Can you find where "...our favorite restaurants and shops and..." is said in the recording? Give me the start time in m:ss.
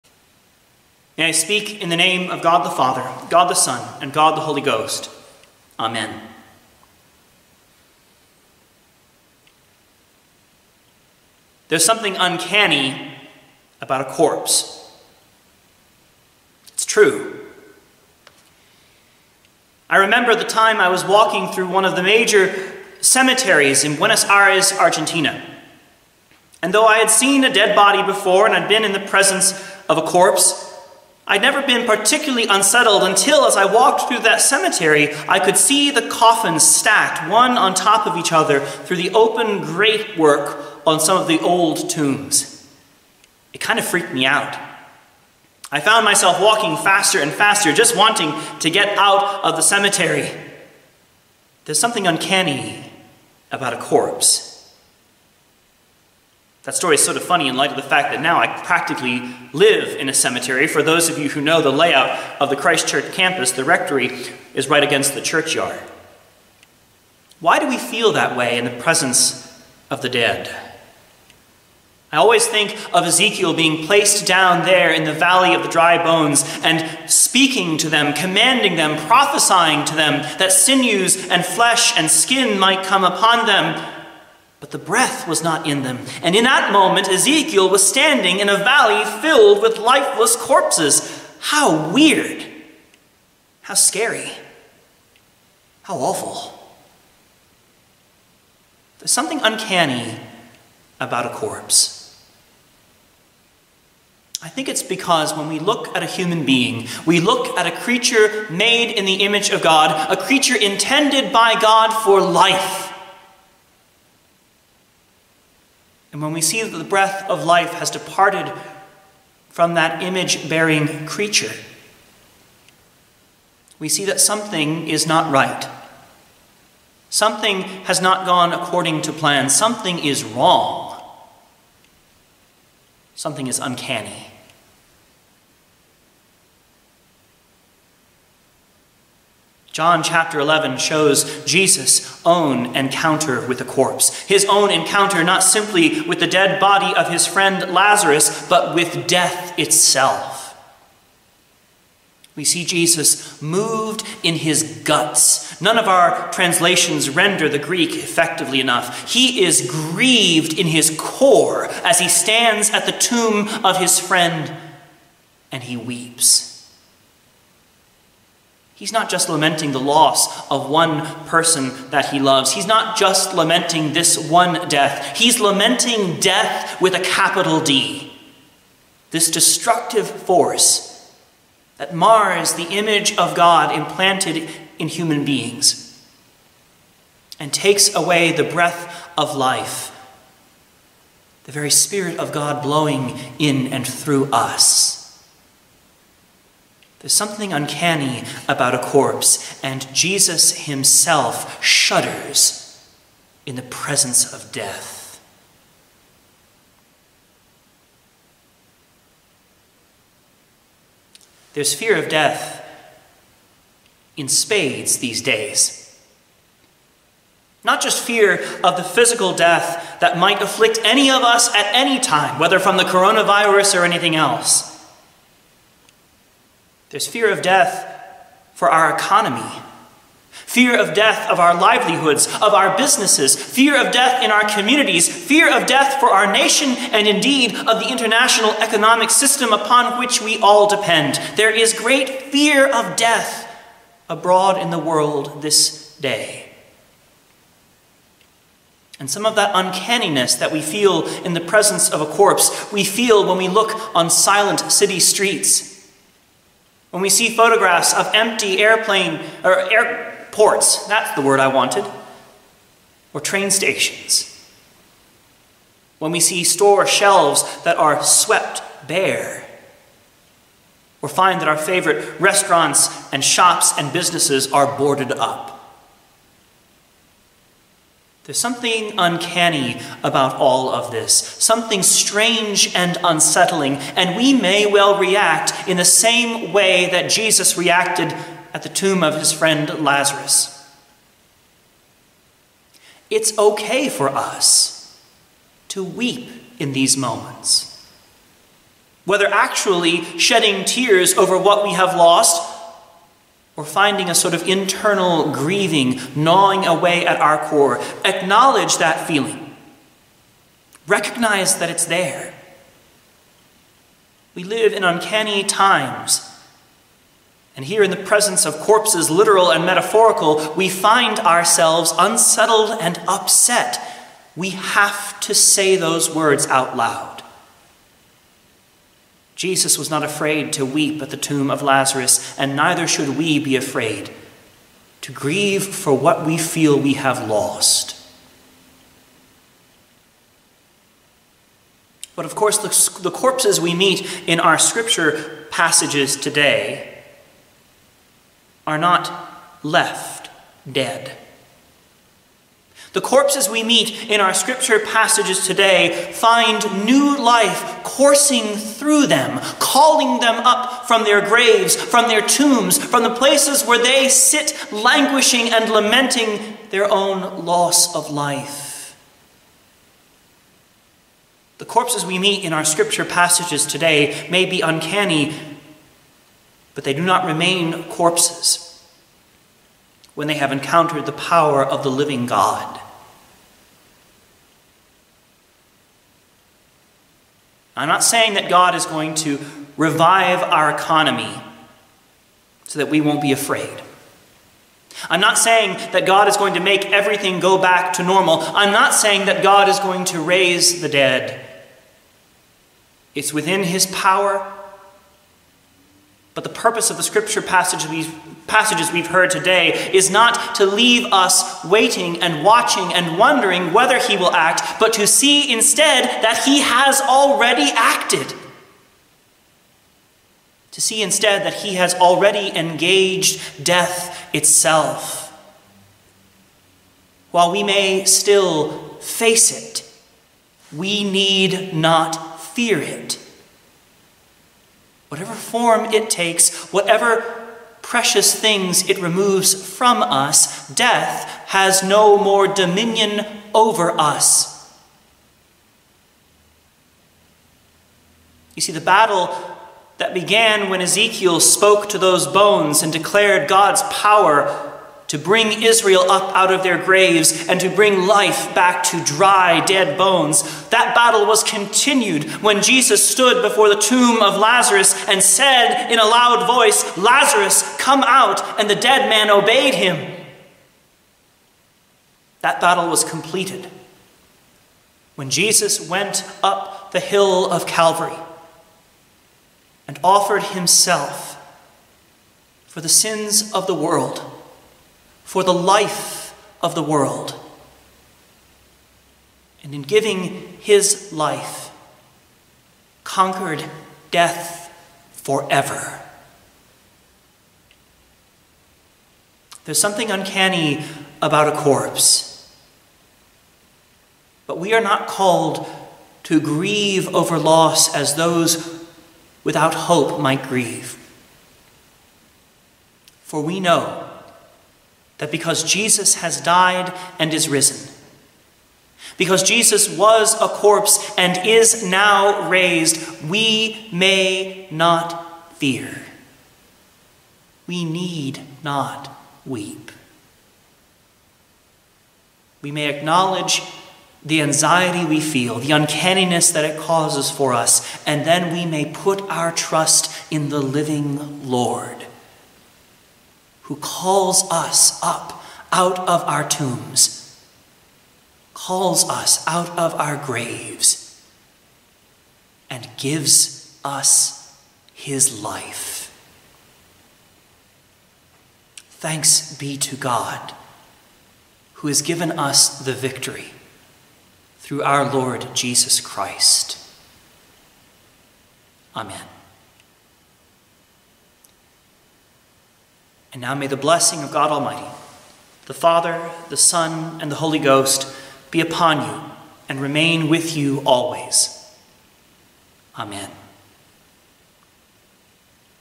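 4:31.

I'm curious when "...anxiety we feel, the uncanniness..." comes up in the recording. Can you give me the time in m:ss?
8:54.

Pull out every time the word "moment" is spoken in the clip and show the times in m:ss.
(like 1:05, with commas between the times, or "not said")
1:26, 4:56.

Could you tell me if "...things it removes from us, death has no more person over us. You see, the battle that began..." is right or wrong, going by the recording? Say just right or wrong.
wrong.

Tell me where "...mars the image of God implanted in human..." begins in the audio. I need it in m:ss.
3:01.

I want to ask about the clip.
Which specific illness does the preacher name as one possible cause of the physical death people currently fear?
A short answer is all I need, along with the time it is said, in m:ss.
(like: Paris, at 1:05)
coronavirus, at 3:42.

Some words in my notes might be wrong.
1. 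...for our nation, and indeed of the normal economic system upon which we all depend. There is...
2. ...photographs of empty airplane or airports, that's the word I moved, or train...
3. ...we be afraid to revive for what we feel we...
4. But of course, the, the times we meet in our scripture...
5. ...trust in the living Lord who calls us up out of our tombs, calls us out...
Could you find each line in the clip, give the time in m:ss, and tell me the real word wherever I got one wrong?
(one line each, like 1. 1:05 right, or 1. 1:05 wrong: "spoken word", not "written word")
1. 3:56 wrong: "international", not "normal"
2. 4:17 wrong: "wanted", not "moved"
3. 5:33 wrong: "grieve", not "revive"
4. 5:42 wrong: "corpses", not "times"
5. 8:59 right.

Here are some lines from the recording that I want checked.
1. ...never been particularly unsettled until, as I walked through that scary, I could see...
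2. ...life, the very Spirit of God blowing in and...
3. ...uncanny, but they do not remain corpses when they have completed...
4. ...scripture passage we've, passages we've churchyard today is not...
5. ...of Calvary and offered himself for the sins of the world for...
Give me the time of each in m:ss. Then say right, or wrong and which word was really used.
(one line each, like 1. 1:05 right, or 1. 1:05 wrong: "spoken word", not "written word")
1. 0:31 wrong: "cemetery", not "scary"
2. 3:09 right
3. 6:14 wrong: "encountered", not "completed"
4. 6:47 wrong: "heard", not "churchyard"
5. 7:57 right.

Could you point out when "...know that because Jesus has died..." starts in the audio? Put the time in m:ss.
8:33.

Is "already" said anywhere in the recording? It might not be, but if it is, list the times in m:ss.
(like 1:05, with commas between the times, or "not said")
6:57, 7:01.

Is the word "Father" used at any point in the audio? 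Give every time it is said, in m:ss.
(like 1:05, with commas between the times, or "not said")
0:02, 9:35.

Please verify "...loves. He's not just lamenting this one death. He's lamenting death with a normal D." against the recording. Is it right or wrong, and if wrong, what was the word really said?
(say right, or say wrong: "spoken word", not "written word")
wrong: "capital", not "normal".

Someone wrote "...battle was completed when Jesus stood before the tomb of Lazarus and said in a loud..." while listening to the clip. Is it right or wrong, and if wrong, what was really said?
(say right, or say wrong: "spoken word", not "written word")
wrong: "continued", not "completed".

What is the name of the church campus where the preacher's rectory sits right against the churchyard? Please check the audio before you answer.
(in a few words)
Christ Church.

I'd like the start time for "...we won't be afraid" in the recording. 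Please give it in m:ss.
6:32.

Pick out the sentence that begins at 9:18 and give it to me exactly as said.
Thanks be to God, who has given us the victory through our Lord Jesus Christ.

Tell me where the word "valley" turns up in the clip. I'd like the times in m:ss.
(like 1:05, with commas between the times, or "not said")
1:15, 1:28.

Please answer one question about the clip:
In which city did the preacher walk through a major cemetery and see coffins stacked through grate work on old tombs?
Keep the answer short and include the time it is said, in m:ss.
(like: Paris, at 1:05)
Buenos Aires, at 0:23.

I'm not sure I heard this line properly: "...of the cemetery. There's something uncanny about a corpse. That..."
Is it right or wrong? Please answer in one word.
right.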